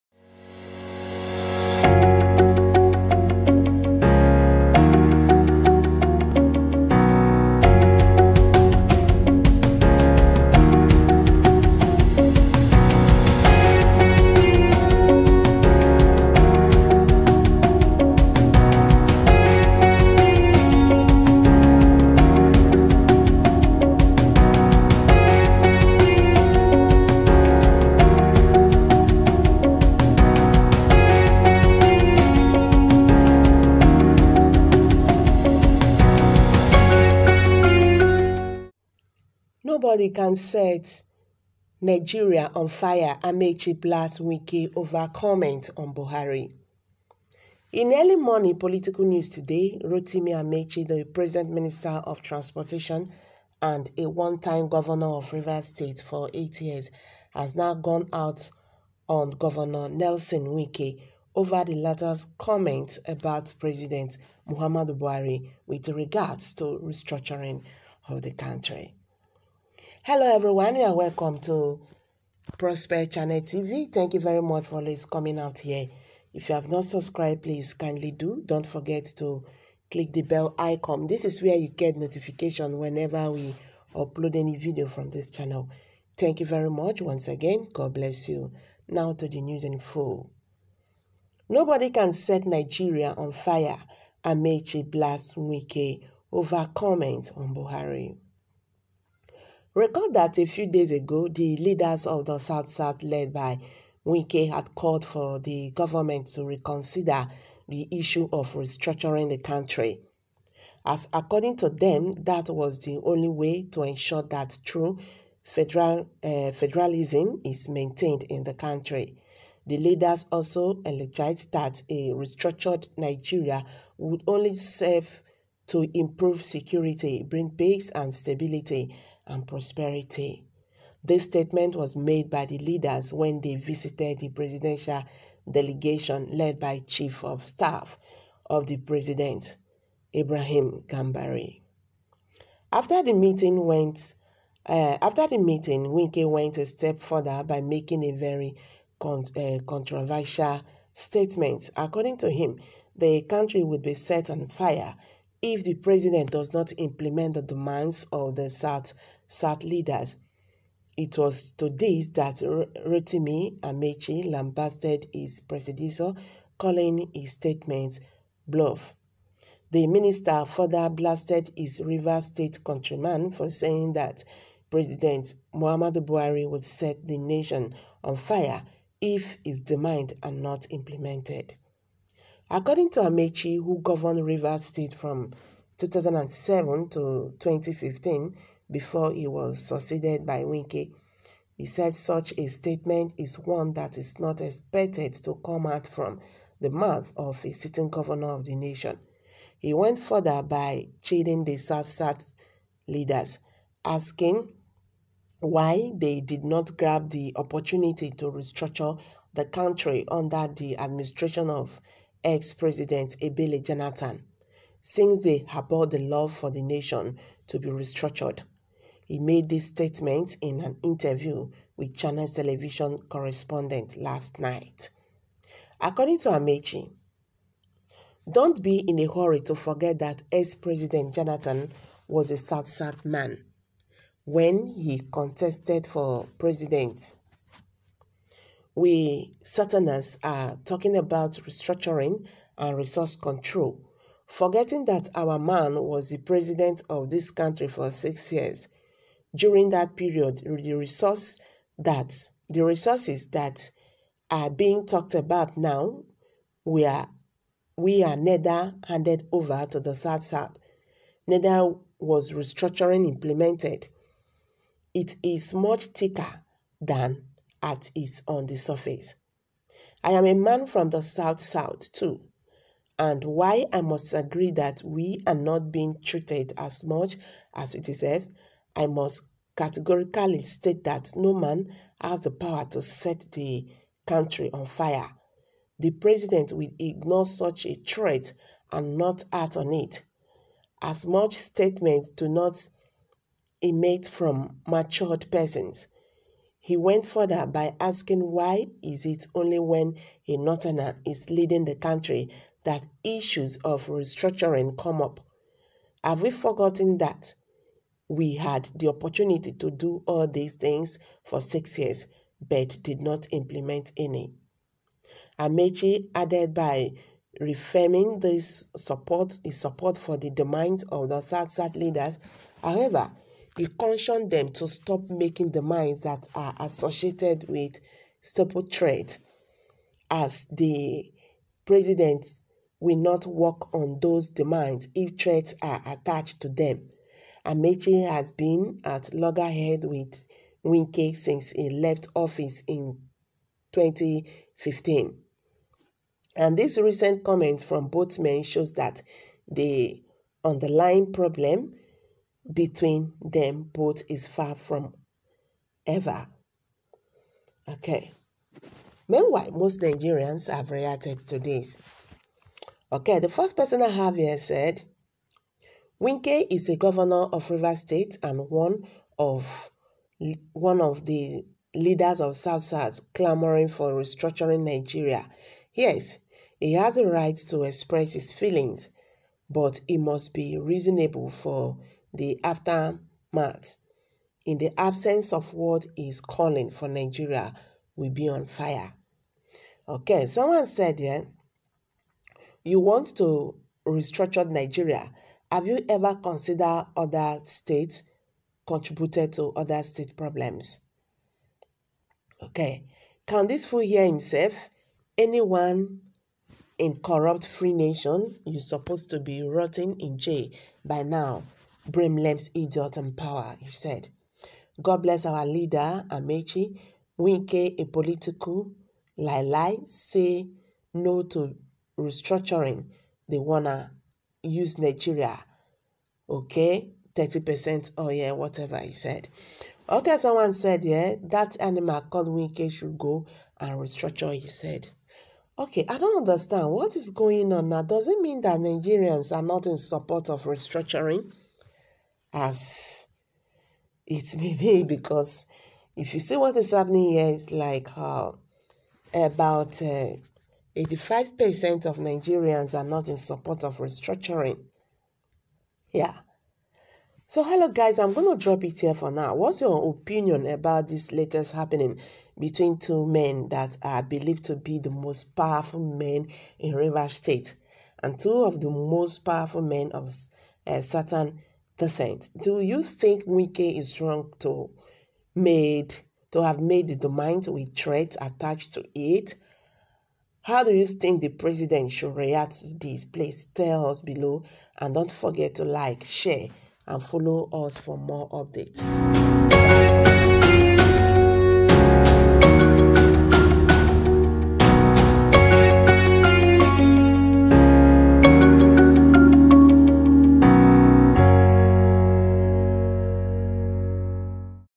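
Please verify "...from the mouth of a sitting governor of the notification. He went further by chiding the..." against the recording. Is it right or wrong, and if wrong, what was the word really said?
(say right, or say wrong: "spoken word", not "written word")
wrong: "nation", not "notification".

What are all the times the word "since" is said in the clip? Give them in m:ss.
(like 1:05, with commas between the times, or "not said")
3:34, 5:41.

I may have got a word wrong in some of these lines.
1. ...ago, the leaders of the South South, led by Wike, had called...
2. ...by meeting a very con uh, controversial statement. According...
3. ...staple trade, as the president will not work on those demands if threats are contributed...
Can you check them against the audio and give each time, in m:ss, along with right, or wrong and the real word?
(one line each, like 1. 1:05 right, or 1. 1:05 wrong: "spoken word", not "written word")
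1. 1:40 right
2. 2:27 wrong: "making", not "meeting"
3. 5:28 wrong: "attached", not "contributed".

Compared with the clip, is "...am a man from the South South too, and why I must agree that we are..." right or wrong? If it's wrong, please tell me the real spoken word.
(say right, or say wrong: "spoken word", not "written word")
right.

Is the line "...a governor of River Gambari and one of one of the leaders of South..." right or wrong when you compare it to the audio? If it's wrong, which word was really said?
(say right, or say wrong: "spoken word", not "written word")
wrong: "State", not "Gambari".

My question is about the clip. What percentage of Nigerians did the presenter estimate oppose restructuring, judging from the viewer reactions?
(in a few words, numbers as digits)
85%.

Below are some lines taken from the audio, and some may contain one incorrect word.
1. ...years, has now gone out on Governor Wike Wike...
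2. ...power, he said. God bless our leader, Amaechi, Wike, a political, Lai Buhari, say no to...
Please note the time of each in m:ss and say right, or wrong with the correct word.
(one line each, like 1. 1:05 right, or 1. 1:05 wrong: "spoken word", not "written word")
1. 0:56 wrong: "Nelson", not "Wike"
2. 6:53 wrong: "Lai", not "Buhari".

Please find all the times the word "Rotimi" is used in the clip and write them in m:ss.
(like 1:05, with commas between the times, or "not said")
0:49, 2:42.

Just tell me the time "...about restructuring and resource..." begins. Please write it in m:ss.
4:00.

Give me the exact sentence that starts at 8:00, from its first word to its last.
How do you think the president should react to this?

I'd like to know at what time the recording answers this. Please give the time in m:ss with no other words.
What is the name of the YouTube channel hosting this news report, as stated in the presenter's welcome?
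1:12.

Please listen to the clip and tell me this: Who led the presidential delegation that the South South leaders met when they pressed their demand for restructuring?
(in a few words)
Ibrahim Gambari.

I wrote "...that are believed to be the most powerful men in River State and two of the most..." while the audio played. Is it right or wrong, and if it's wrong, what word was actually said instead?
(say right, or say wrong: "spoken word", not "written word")
right.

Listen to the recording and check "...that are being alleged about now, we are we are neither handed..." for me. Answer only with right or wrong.
wrong.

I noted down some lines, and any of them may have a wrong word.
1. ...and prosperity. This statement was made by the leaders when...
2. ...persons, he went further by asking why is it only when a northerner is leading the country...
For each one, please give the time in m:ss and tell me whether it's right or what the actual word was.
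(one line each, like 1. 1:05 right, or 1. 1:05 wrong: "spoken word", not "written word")
1. 2:09 right
2. 4:55 right.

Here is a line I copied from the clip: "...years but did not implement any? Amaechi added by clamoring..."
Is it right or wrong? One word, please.
wrong.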